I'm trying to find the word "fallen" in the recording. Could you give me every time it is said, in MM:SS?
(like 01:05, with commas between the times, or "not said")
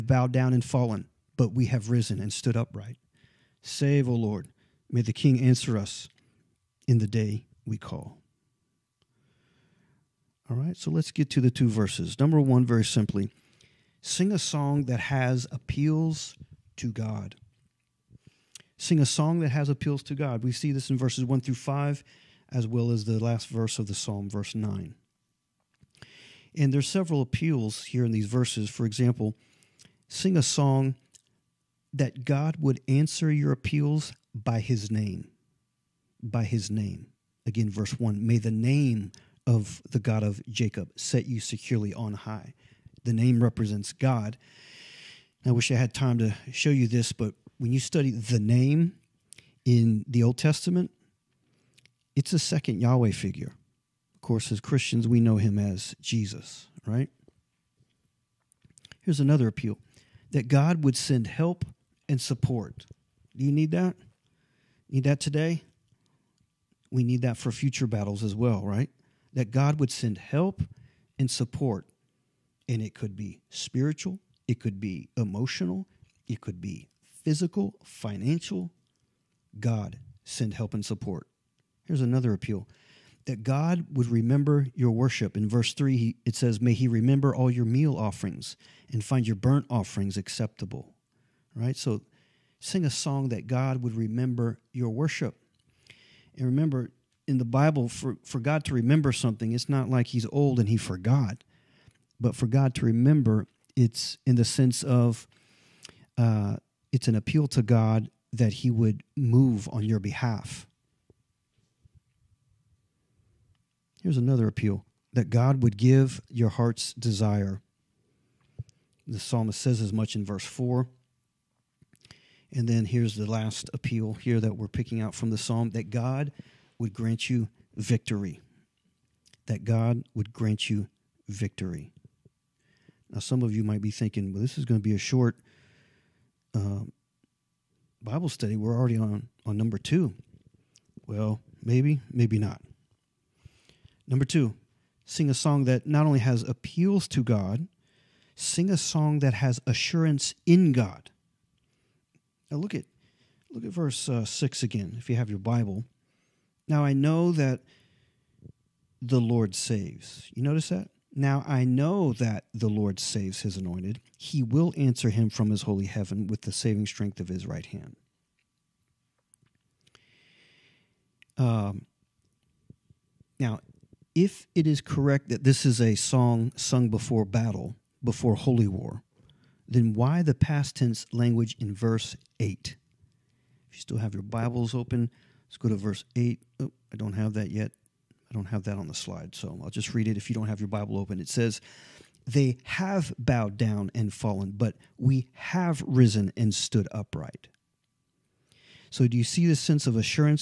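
00:00, 03:14.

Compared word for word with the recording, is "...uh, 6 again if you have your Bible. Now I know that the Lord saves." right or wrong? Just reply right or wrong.
right.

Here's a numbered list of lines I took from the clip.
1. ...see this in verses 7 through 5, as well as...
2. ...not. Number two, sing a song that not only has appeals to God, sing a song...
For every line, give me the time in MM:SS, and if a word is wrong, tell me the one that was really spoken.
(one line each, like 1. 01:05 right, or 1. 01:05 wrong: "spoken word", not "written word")
1. 00:20 wrong: "1", not "7"
2. 02:22 right.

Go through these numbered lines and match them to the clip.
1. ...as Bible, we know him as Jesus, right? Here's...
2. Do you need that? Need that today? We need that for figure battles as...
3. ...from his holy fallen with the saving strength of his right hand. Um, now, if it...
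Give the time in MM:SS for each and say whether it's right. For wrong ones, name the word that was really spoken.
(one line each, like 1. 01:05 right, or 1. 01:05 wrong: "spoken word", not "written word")
1. 00:54 wrong: "Christians", not "Bible"
2. 01:03 wrong: "future", not "figure"
3. 02:45 wrong: "heaven", not "fallen".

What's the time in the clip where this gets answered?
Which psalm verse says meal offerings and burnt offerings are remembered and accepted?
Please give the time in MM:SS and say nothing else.
01:25.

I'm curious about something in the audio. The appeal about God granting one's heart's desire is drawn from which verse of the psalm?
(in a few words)
Verse 4.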